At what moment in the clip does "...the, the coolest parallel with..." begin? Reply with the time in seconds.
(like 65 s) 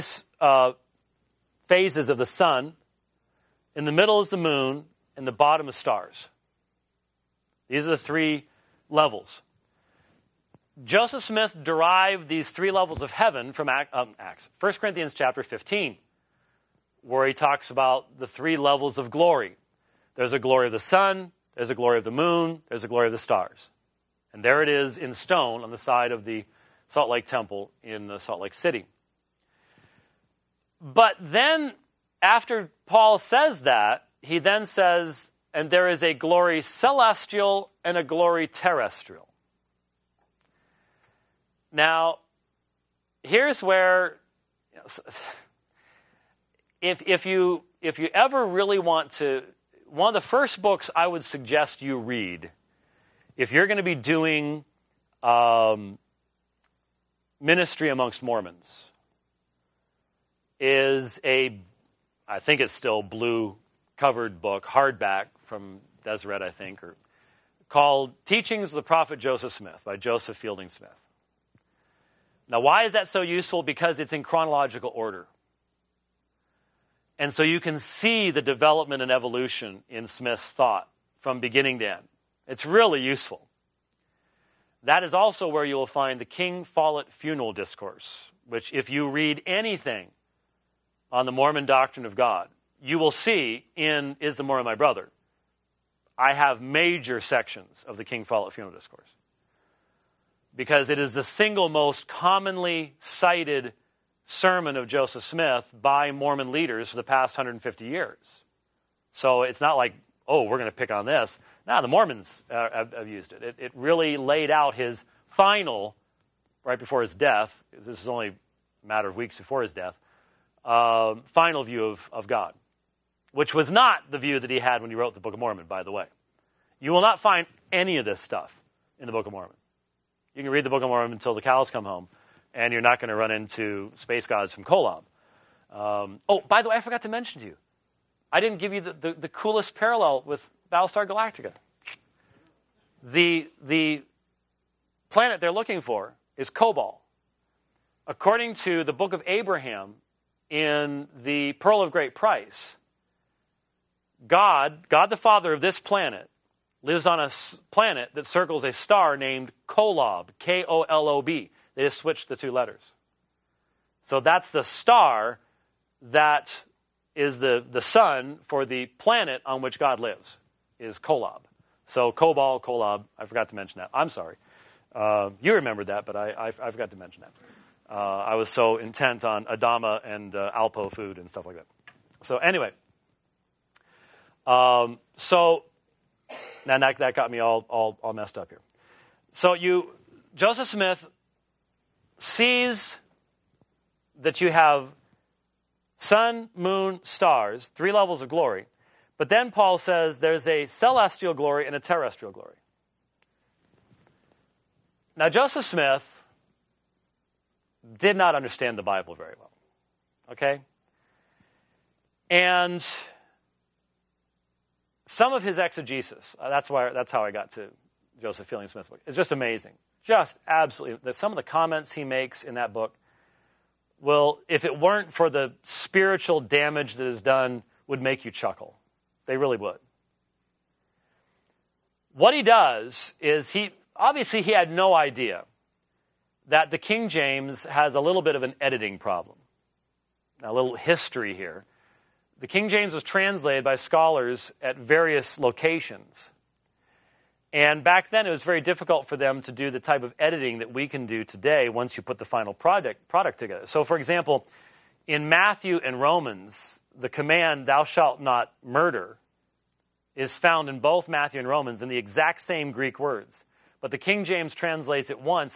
138 s.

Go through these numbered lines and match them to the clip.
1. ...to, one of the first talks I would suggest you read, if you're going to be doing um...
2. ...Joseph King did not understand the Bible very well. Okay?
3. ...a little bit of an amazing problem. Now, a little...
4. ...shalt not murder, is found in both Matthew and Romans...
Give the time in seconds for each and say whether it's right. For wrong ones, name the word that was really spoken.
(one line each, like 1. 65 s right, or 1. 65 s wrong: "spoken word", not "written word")
1. 49 s wrong: "books", not "talks"
2. 205 s wrong: "Smith", not "King"
3. 237 s wrong: "editing", not "amazing"
4. 257 s right.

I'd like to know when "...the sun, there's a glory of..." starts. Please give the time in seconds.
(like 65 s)
20 s.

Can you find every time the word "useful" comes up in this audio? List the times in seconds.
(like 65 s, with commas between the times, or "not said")
73 s, 83 s.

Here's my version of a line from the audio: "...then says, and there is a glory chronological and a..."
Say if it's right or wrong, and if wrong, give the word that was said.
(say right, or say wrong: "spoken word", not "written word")
wrong: "celestial", not "chronological".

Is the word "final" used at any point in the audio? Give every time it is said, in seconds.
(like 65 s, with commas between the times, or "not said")
115 s, 121 s, 252 s.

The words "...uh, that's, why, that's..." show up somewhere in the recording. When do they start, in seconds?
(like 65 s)
216 s.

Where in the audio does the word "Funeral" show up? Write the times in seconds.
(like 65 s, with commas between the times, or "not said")
87 s, 98 s.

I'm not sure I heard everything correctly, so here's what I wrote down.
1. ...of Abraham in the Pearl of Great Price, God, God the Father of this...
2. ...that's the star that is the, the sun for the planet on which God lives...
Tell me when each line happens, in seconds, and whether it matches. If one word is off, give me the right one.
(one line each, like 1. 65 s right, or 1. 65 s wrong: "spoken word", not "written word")
1. 149 s right
2. 164 s right.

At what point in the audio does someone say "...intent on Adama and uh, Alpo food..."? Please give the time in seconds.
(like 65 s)
178 s.